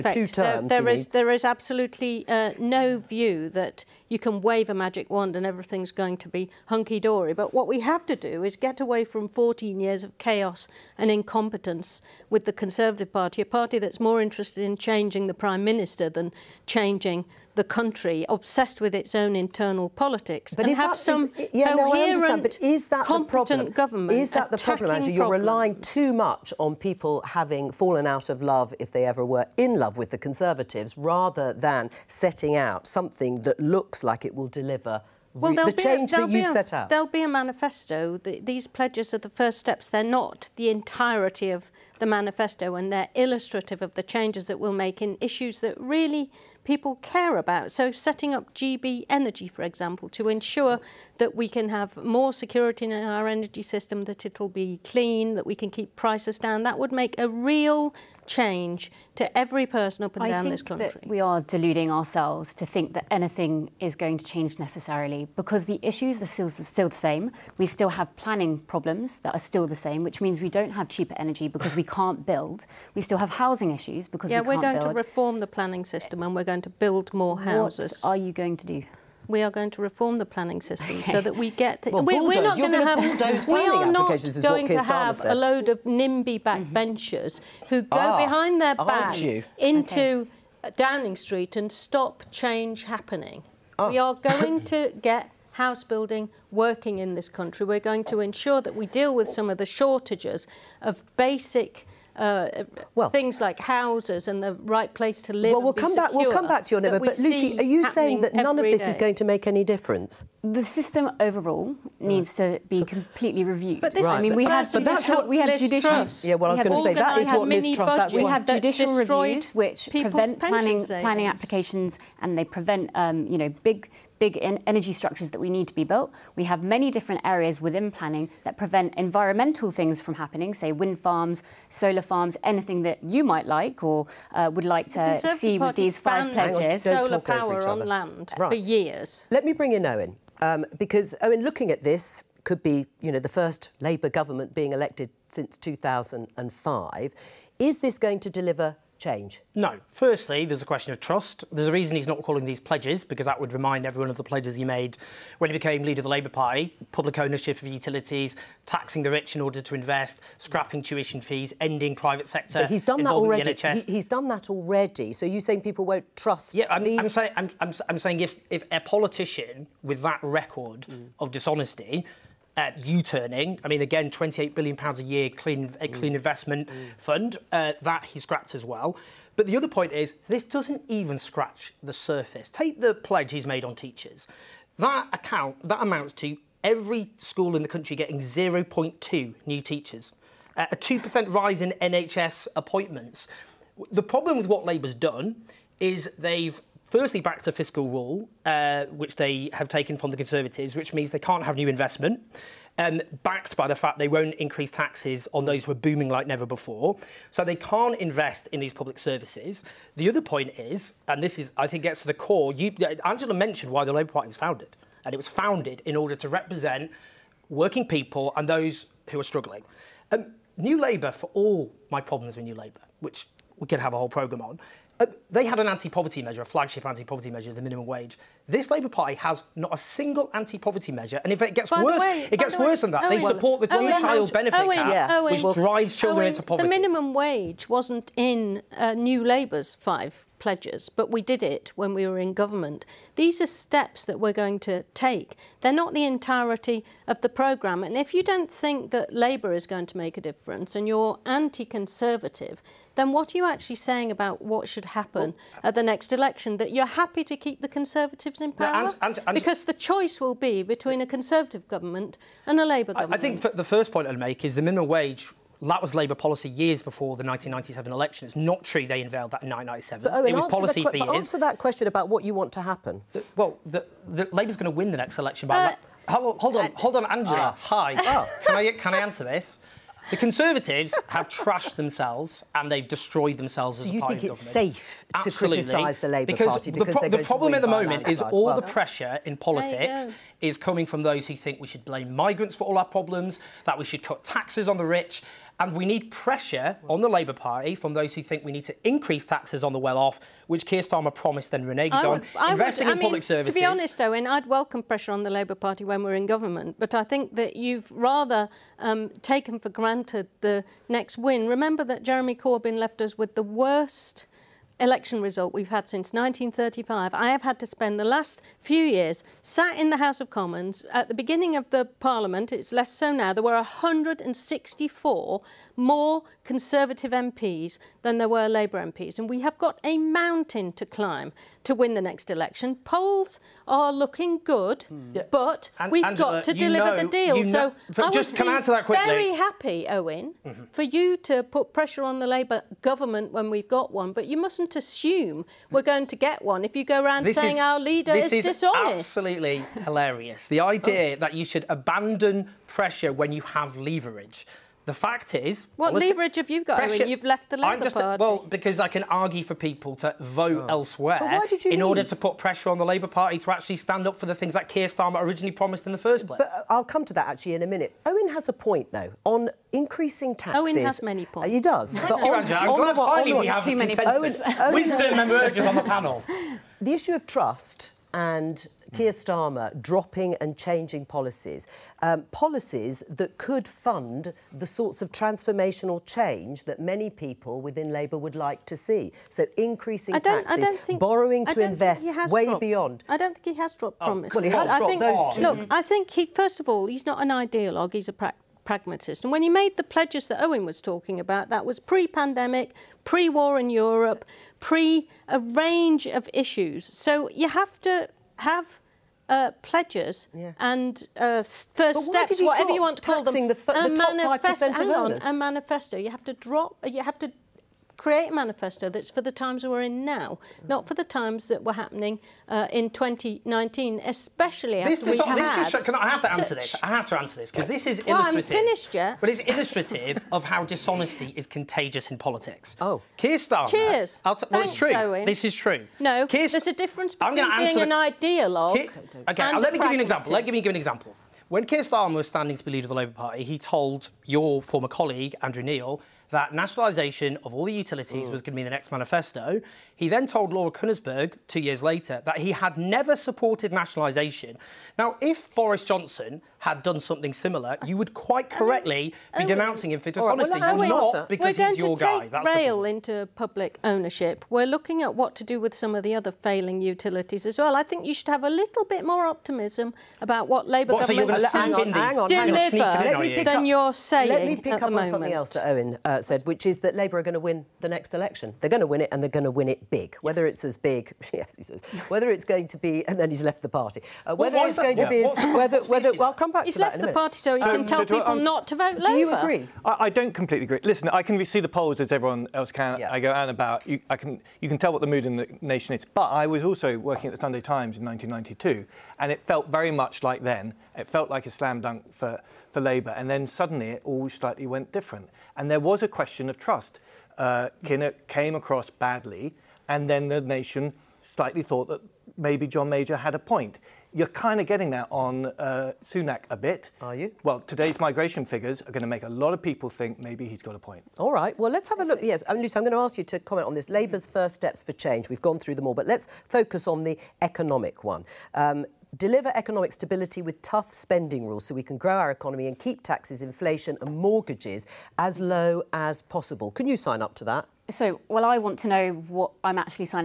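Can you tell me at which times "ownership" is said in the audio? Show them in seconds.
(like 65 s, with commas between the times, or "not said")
157 s, 463 s.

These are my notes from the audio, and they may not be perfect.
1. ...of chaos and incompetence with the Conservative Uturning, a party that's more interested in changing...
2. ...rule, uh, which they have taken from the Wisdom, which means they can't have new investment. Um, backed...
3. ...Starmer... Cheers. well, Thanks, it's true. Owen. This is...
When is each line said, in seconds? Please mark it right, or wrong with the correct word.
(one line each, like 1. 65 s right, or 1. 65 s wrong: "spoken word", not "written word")
1. 10 s wrong: "Party", not "Uturning"
2. 197 s wrong: "Conservatives", not "Wisdom"
3. 433 s right.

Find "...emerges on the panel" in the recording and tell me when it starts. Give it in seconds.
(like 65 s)
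375 s.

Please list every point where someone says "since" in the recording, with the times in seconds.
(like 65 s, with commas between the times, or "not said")
145 s, 315 s.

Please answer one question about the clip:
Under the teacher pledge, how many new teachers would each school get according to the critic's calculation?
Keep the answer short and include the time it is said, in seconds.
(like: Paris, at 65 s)
0.2, at 188 s.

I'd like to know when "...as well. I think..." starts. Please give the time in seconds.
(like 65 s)
467 s.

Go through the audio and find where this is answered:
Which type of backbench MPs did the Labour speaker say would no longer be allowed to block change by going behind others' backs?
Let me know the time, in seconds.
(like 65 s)
85 s.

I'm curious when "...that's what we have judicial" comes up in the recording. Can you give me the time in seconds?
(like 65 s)
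114 s.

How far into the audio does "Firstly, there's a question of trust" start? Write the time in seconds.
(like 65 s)
149 s.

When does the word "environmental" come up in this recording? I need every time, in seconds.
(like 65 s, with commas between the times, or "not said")
128 s.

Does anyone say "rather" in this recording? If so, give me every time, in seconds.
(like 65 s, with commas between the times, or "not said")
30 s, 307 s.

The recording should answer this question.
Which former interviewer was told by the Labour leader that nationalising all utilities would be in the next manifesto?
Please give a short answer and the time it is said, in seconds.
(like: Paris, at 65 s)
Andrew Neil, at 445 s.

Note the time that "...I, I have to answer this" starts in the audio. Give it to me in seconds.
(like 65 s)
425 s.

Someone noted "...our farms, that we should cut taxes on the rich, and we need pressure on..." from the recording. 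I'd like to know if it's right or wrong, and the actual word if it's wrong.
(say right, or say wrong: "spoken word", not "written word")
wrong: "problems", not "farms".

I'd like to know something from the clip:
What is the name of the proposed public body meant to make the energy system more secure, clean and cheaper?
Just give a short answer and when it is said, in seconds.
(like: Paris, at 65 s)
GB Energy, at 48 s.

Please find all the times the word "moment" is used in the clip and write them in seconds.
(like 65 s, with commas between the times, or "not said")
287 s, 474 s.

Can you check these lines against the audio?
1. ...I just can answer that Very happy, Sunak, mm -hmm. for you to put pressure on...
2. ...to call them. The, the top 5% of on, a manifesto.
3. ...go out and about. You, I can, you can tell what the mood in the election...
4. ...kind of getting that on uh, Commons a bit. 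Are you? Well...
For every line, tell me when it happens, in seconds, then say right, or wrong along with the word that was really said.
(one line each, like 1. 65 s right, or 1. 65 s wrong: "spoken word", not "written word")
1. 338 s wrong: "Owen", not "Sunak"
2. 412 s right
3. 493 s wrong: "nation", not "election"
4. 514 s wrong: "Sunak", not "Commons".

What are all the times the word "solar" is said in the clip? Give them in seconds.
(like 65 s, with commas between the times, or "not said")
131 s, 137 s.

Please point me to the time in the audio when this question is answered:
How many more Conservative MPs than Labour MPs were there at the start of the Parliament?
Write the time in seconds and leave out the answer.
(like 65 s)
323 s.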